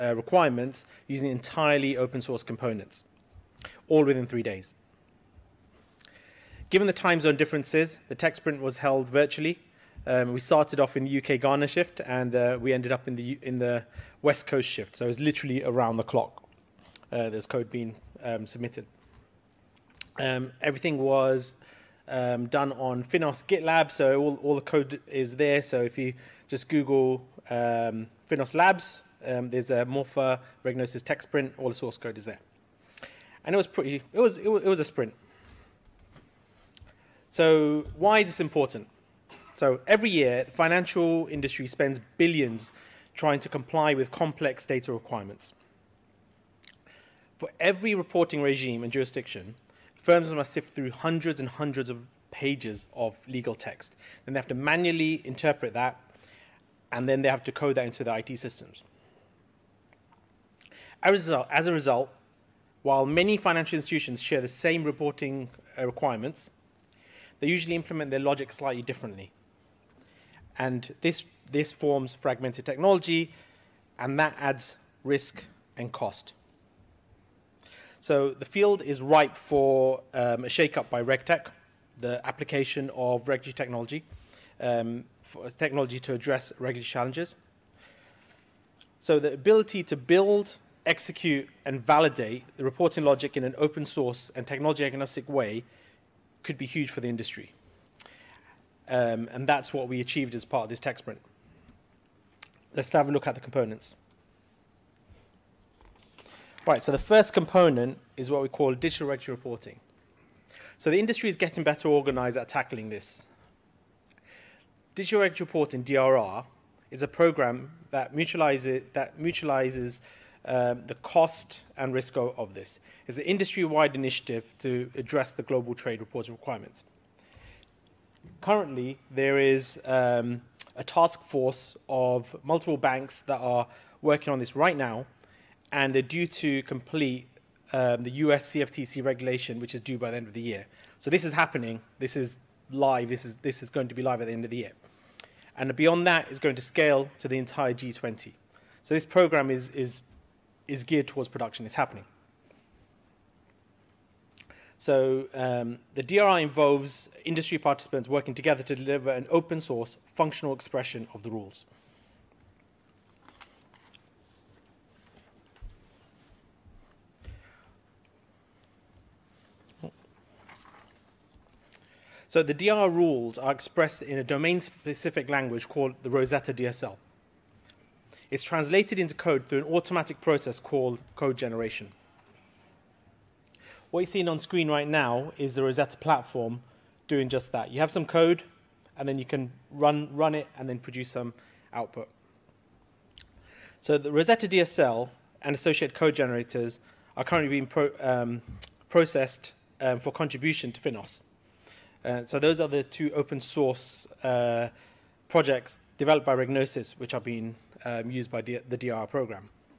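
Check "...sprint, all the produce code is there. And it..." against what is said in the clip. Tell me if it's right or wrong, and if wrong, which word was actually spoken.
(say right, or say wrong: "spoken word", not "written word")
wrong: "source", not "produce".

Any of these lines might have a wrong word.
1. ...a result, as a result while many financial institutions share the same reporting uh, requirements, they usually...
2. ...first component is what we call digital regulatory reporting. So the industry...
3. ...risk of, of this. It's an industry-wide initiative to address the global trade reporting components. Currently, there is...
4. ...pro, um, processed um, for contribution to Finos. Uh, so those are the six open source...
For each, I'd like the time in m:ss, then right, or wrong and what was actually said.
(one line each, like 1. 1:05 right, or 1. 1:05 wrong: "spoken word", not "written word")
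1. 1:01 right
2. 1:46 right
3. 2:01 wrong: "requirements", not "components"
4. 3:17 wrong: "two", not "six".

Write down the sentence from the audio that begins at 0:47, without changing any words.
For every reporting regime and jurisdiction, firms must sift through hundreds and hundreds of pages of legal text.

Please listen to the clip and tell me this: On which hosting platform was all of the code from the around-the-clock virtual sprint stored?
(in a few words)
Finos GitLab.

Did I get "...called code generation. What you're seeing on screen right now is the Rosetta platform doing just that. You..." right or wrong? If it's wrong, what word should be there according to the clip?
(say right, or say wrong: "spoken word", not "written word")
right.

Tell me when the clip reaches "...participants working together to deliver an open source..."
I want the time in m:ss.
2:37.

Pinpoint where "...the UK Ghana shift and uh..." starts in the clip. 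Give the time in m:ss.
0:11.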